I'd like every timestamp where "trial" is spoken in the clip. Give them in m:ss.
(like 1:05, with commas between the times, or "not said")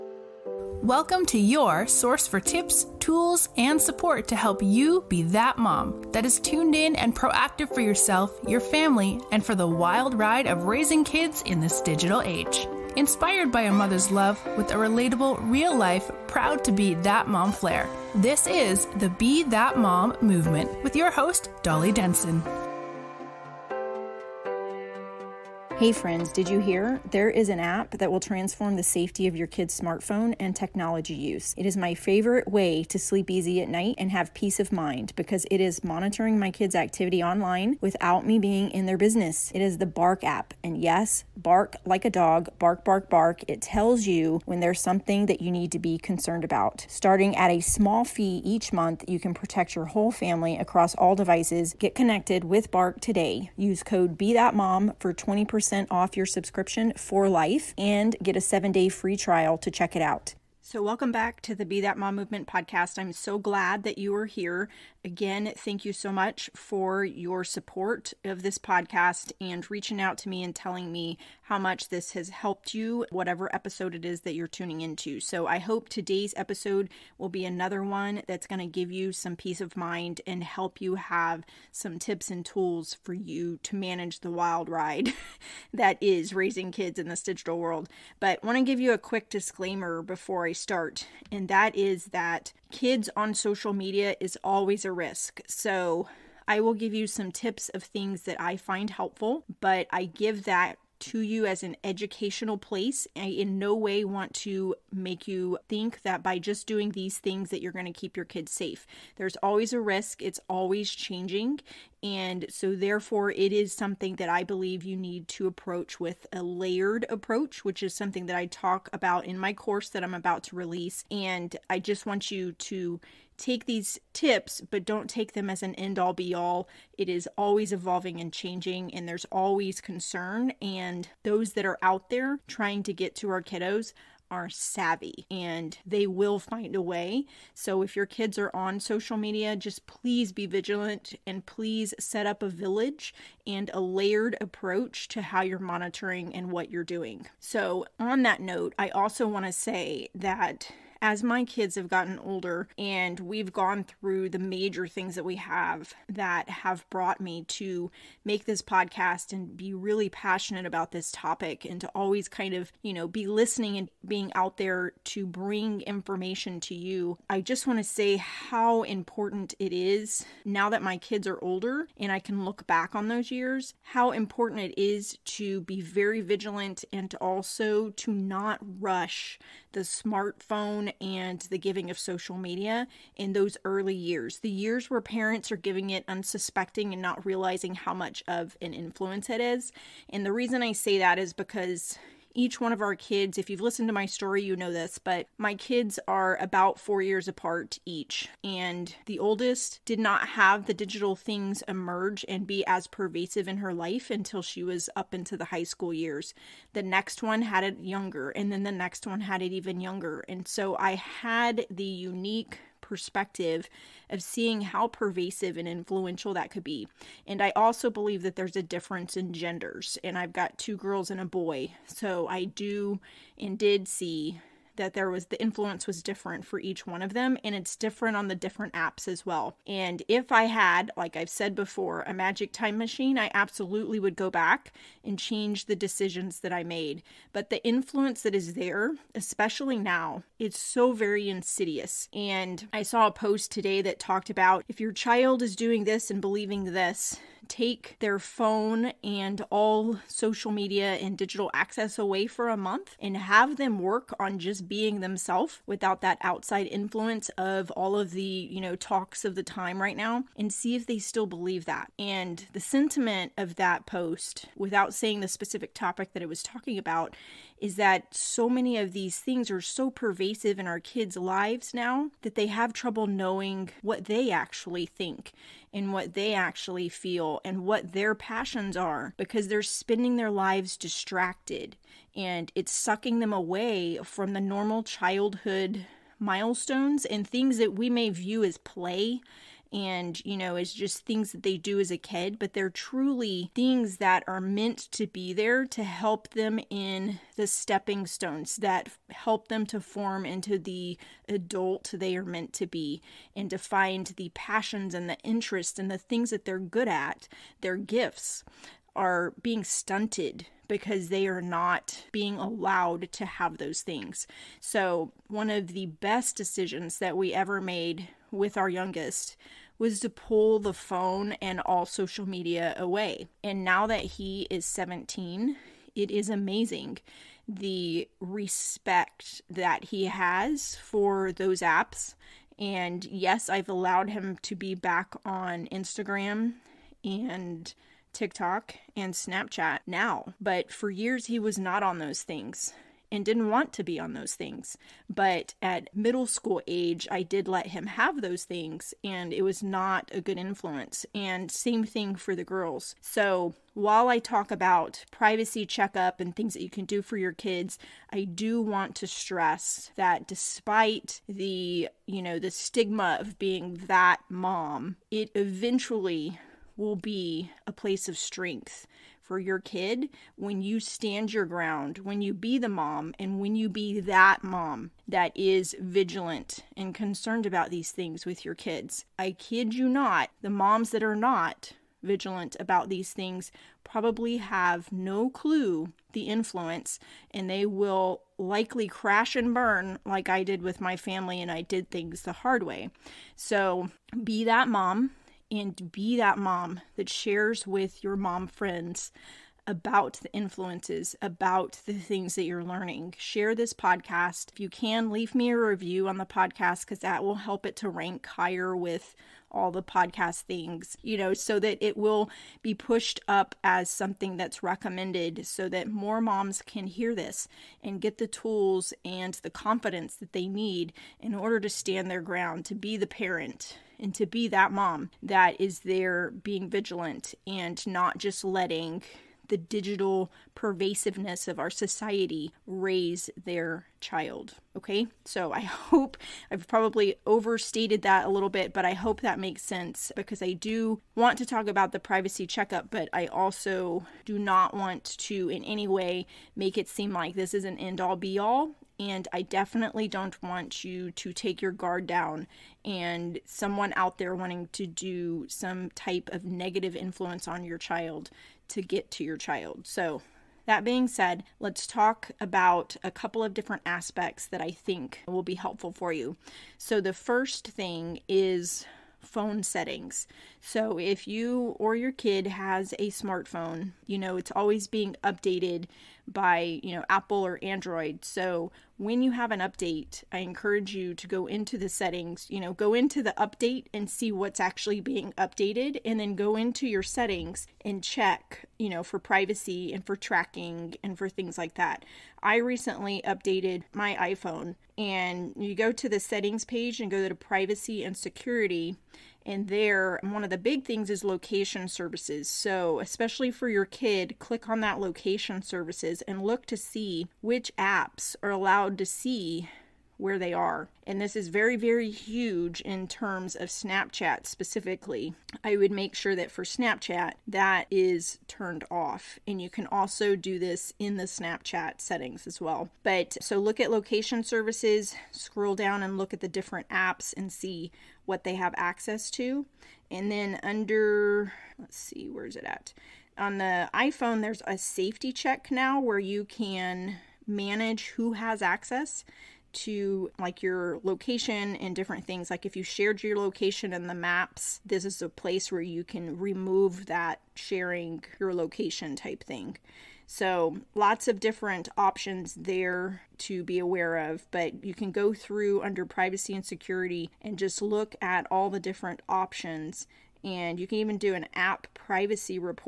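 0:59.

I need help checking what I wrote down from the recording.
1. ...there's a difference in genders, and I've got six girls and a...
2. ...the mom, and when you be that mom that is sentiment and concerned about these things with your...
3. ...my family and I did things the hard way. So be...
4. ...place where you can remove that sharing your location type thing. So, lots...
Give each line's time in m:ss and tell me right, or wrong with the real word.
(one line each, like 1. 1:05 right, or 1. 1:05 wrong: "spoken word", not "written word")
1. 3:38 wrong: "two", not "six"
2. 6:12 wrong: "vigilant", not "sentiment"
3. 6:30 right
4. 9:05 right.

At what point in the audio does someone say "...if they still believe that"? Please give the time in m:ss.
4:20.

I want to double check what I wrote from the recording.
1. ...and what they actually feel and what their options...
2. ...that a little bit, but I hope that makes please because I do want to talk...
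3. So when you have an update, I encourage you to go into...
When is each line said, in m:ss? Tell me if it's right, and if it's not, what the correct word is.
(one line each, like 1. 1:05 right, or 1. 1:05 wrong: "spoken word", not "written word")
1. 4:35 wrong: "passions", not "options"
2. 7:18 wrong: "sense", not "please"
3. 7:58 right.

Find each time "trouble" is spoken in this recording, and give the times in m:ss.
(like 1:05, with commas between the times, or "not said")
4:32.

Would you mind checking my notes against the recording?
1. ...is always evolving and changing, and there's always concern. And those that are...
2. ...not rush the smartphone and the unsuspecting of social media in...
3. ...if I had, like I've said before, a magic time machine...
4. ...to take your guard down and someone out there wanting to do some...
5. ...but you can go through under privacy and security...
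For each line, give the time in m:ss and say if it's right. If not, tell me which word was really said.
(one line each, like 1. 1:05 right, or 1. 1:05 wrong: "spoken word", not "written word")
1. 2:07 right
2. 2:58 wrong: "giving", not "unsuspecting"
3. 3:50 right
4. 7:31 right
5. 9:14 right.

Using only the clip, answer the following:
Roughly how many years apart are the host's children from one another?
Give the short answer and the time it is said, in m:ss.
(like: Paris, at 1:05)
4 years, at 3:16.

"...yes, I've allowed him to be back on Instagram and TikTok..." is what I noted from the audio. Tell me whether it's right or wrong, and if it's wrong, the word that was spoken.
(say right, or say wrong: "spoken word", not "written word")
right.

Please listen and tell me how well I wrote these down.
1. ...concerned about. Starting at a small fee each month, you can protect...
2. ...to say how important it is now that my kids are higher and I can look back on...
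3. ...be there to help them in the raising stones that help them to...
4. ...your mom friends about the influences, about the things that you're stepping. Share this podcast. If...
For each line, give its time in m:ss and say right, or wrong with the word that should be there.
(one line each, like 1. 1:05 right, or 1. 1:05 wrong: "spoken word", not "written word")
1. 0:45 right
2. 2:47 wrong: "older", not "higher"
3. 4:55 wrong: "stepping", not "raising"
4. 6:38 wrong: "learning", not "stepping".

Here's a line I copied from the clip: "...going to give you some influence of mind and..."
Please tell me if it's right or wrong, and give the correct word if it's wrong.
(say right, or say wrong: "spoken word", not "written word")
wrong: "peace", not "influence".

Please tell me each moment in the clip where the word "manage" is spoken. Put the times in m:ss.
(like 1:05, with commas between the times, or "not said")
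1:23, 8:57.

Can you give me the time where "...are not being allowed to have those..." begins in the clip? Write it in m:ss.
5:11.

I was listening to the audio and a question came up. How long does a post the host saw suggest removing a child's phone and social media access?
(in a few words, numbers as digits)
a month.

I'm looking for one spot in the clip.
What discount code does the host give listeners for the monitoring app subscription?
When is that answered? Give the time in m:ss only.
0:53.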